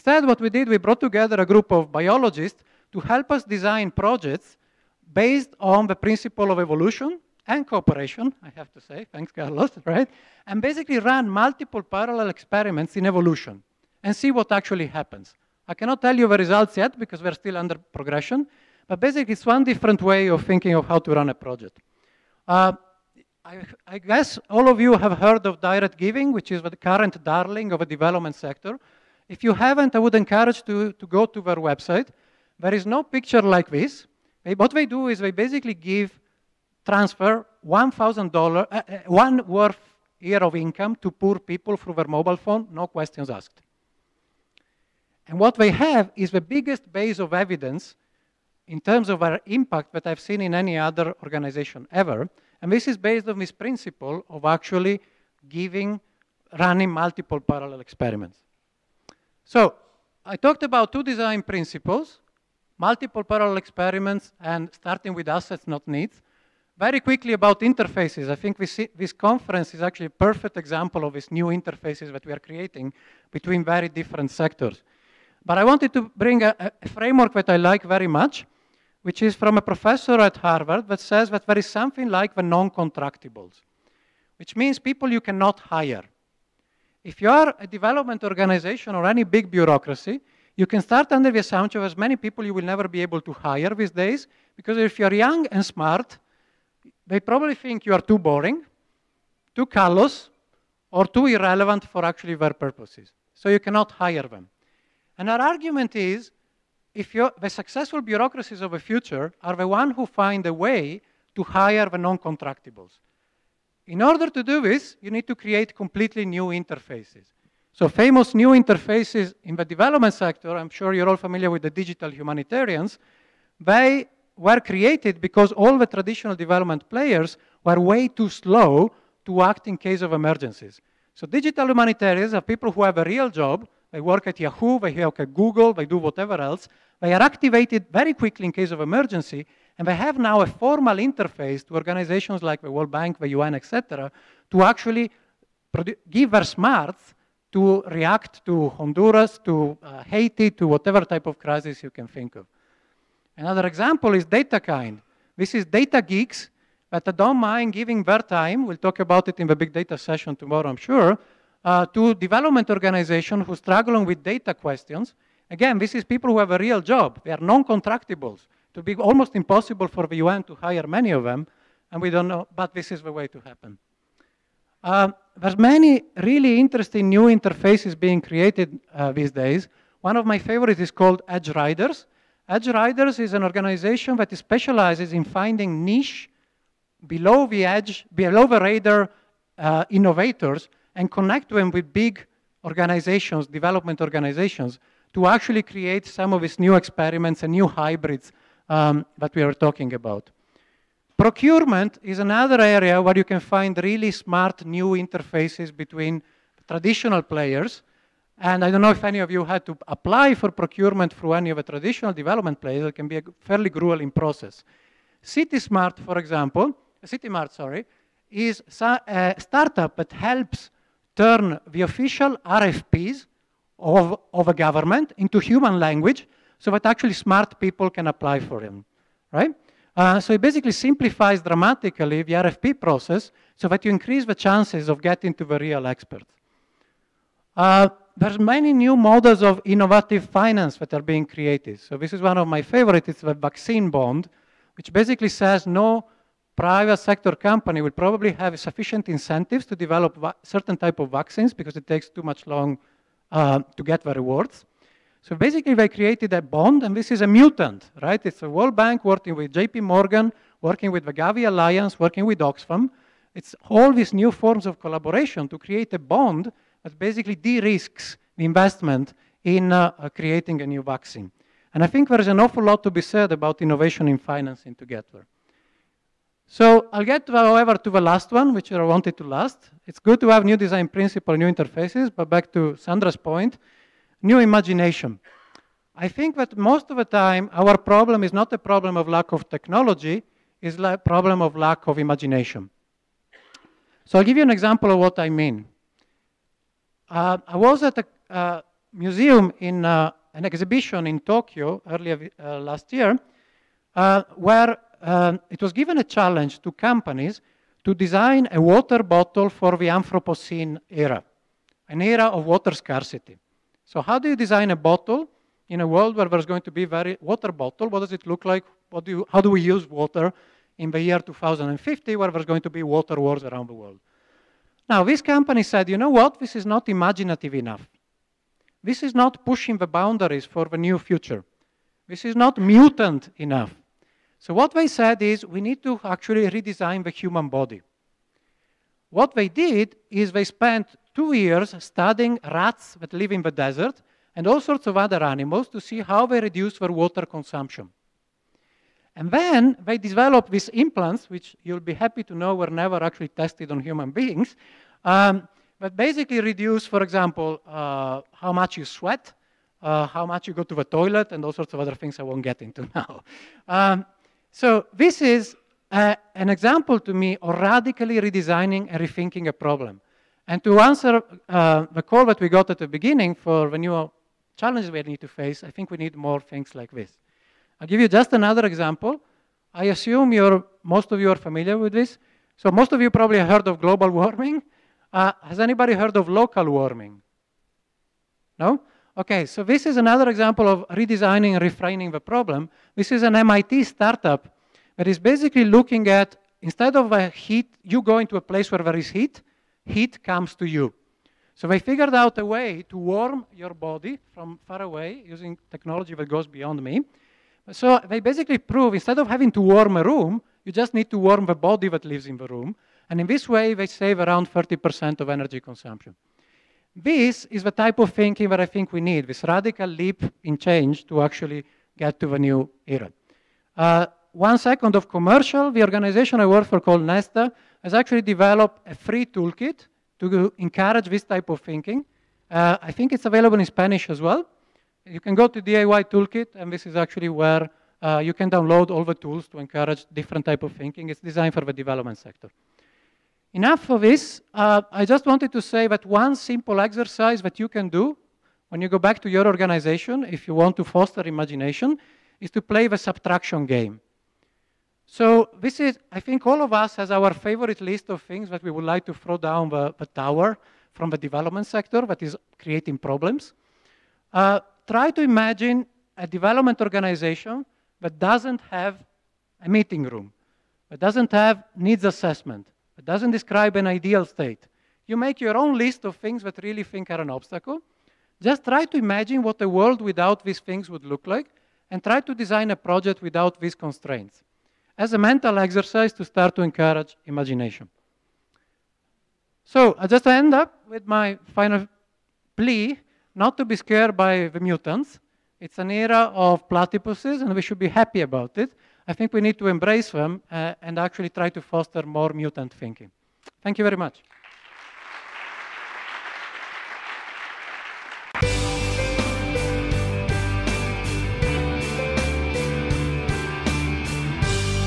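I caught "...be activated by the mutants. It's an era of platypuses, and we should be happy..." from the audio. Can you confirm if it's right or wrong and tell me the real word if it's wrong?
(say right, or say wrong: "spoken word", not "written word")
wrong: "scared", not "activated".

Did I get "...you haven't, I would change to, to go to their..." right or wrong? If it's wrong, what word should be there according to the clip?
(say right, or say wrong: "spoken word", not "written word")
wrong: "encourage", not "change".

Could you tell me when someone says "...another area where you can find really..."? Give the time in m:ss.
3:22.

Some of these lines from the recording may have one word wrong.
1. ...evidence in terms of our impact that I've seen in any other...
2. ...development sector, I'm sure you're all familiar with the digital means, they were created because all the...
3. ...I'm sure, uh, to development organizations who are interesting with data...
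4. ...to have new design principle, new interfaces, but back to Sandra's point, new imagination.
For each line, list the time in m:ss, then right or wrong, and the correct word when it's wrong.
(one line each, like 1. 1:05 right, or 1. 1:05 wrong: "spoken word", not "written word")
1. 0:47 right
2. 1:59 wrong: "humanitarians", not "means"
3. 2:40 wrong: "struggling", not "interesting"
4. 4:40 right.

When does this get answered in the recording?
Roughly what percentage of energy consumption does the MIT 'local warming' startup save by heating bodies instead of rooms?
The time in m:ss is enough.
6:54.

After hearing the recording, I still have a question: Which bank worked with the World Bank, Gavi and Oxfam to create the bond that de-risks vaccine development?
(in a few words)
JP Morgan.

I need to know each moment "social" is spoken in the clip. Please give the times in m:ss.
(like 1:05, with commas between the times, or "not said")
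not said.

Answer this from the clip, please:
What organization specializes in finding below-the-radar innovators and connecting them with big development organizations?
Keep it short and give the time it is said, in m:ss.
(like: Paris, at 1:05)
Edgeryders, at 3:01.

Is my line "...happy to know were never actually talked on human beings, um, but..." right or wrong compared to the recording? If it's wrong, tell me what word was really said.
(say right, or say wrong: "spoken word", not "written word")
wrong: "tested", not "talked".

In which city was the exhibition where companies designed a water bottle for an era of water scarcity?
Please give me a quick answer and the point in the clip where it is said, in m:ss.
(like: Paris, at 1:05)
Tokyo, at 5:01.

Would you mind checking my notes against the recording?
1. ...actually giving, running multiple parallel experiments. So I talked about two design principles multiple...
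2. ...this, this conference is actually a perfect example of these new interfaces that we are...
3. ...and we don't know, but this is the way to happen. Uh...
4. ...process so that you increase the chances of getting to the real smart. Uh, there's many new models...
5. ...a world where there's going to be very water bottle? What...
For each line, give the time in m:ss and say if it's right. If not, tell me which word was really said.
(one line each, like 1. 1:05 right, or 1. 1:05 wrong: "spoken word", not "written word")
1. 0:54 right
2. 1:08 right
3. 2:51 right
4. 3:52 wrong: "expert", not "smart"
5. 5:15 right.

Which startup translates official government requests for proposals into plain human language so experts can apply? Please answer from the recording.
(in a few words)
CityMart.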